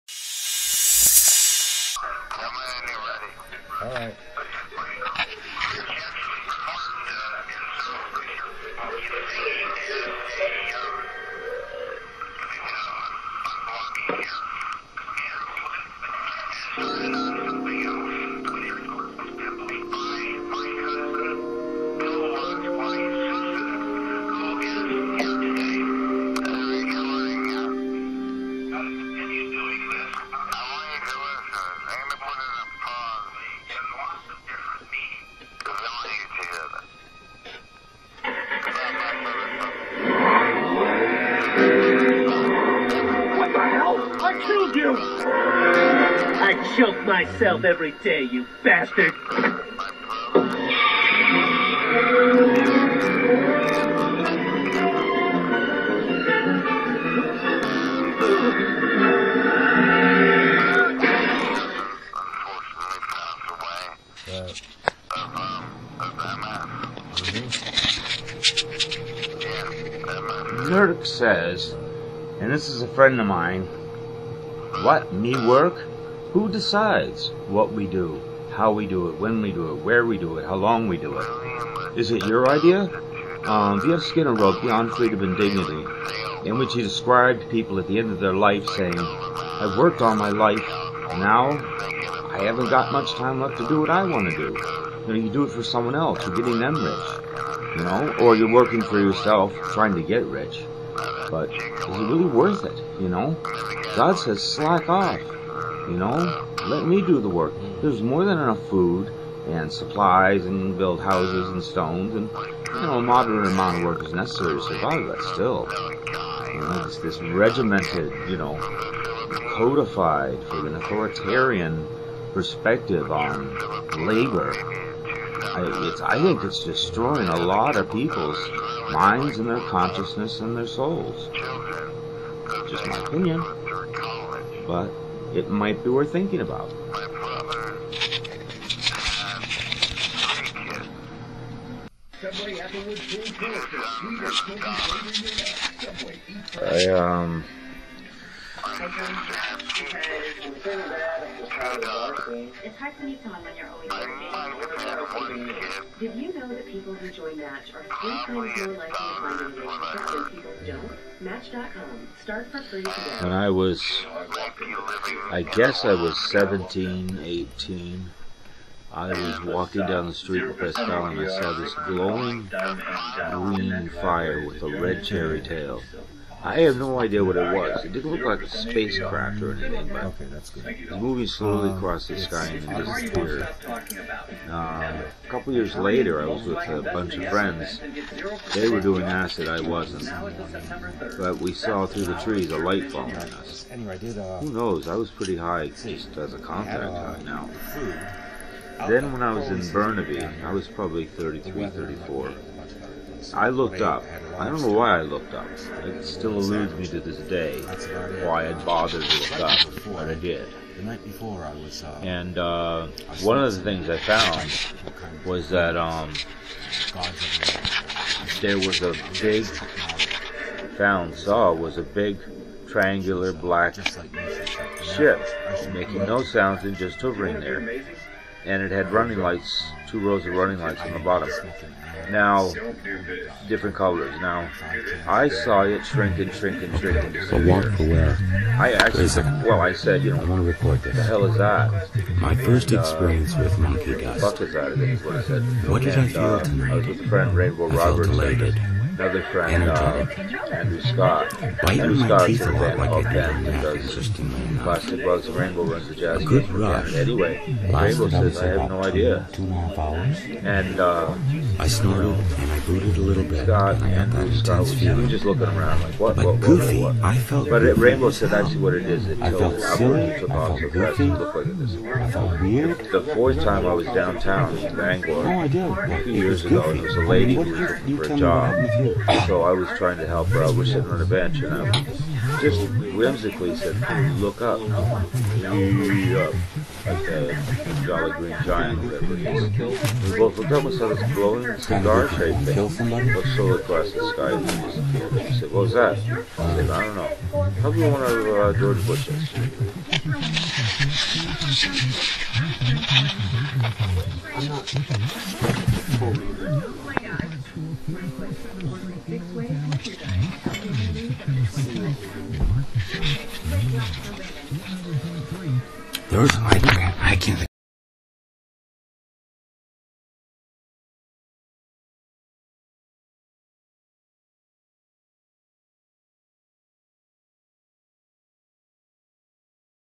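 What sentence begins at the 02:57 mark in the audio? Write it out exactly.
It didn't look like a spacecraft or anything, but okay, that's good.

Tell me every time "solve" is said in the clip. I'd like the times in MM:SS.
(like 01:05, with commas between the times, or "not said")
not said.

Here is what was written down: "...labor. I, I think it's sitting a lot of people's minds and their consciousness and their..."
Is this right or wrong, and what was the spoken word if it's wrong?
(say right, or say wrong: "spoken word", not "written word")
wrong: "destroying", not "sitting".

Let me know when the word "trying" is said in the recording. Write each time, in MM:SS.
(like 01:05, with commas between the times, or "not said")
01:39, 04:39.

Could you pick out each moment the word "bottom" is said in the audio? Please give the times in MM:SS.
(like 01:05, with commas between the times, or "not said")
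03:50.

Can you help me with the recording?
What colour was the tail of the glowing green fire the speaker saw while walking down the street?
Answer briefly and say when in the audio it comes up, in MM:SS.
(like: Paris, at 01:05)
Red, at 02:54.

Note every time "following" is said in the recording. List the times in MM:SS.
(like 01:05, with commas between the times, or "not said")
03:12.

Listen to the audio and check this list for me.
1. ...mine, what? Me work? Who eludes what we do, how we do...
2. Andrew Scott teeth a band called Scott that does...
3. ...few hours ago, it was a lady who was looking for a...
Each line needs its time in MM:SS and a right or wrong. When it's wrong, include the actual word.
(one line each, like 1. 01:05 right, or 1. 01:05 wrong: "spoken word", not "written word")
1. 01:13 wrong: "decides", not "eludes"
2. 04:11 wrong: "Band", not "Scott"
3. 04:36 wrong: "years", not "hours".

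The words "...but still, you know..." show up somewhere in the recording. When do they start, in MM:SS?
01:55.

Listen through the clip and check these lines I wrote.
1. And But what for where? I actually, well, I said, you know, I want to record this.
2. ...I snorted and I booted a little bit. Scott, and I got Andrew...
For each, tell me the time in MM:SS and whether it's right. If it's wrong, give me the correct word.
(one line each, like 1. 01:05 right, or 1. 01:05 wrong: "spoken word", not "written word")
1. 03:57 right
2. 04:21 right.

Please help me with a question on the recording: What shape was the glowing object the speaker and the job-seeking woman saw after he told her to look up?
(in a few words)
Cigar shaped.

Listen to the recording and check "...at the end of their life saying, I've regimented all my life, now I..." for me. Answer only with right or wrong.
wrong.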